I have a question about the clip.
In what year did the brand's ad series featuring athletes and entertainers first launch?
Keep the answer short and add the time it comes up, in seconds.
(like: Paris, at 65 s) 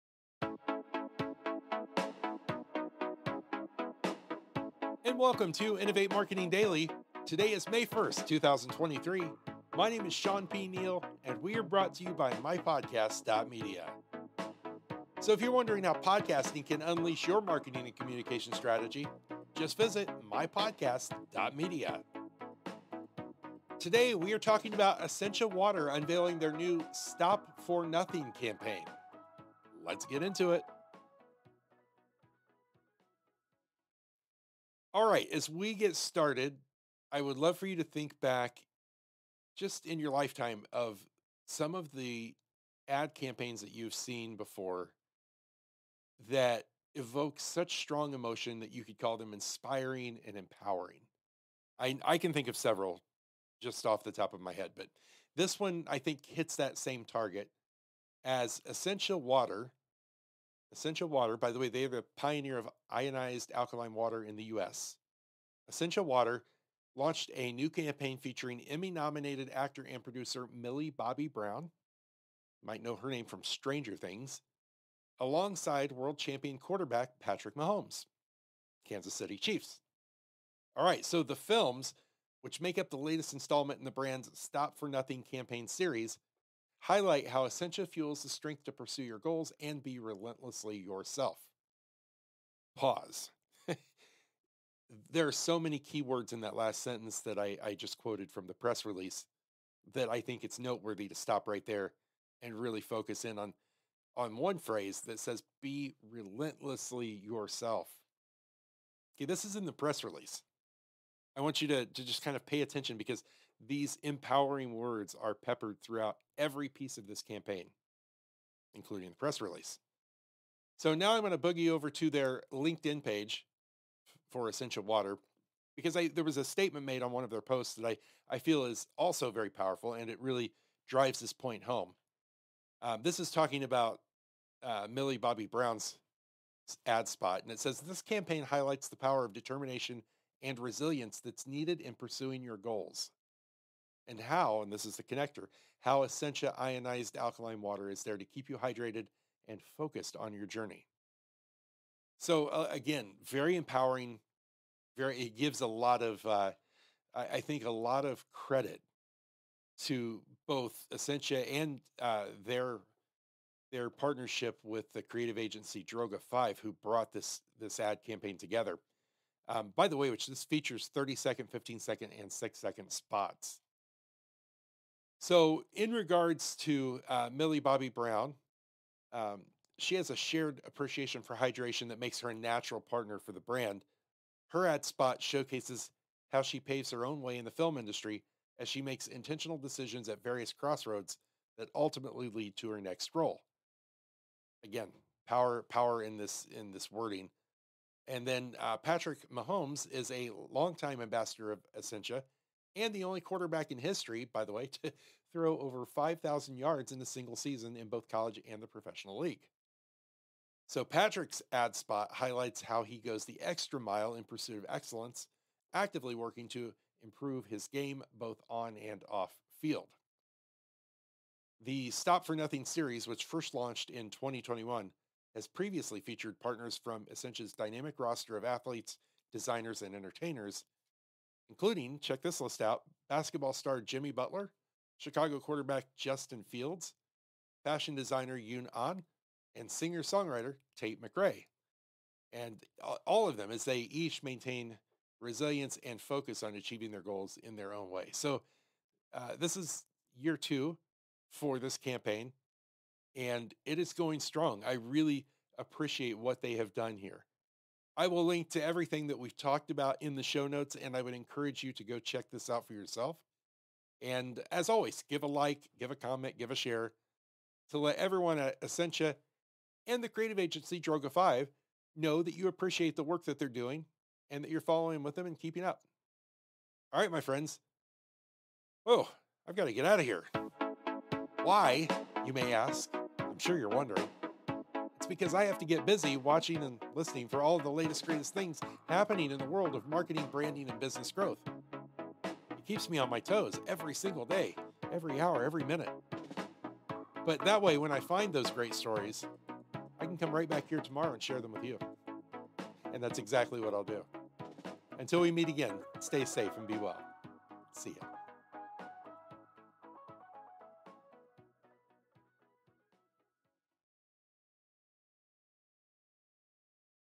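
2021, at 224 s.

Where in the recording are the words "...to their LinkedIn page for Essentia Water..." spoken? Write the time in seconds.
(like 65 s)
121 s.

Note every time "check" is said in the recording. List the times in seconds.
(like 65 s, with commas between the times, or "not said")
231 s, 261 s.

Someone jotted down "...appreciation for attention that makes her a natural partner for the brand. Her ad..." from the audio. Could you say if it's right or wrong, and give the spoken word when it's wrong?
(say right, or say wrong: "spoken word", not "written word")
wrong: "hydration", not "attention".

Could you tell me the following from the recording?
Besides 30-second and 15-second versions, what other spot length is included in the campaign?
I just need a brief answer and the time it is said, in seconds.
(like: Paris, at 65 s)
6 seconds, at 172 s.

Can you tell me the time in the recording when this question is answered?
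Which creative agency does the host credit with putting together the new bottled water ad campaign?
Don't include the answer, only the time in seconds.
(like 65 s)
165 s.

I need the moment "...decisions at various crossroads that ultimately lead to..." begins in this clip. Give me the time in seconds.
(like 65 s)
189 s.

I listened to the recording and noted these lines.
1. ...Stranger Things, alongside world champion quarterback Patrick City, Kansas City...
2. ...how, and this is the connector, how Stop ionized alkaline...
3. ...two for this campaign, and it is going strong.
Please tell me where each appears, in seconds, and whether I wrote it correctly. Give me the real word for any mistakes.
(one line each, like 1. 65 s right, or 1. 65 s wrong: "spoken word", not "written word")
1. 73 s wrong: "Mahomes", not "City"
2. 144 s wrong: "Essentia", not "Stop"
3. 250 s right.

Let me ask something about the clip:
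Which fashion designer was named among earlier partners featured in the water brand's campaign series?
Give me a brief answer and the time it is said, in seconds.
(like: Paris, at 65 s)
Yoon Ahn, at 238 s.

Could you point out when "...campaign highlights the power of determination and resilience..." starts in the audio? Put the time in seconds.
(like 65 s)
138 s.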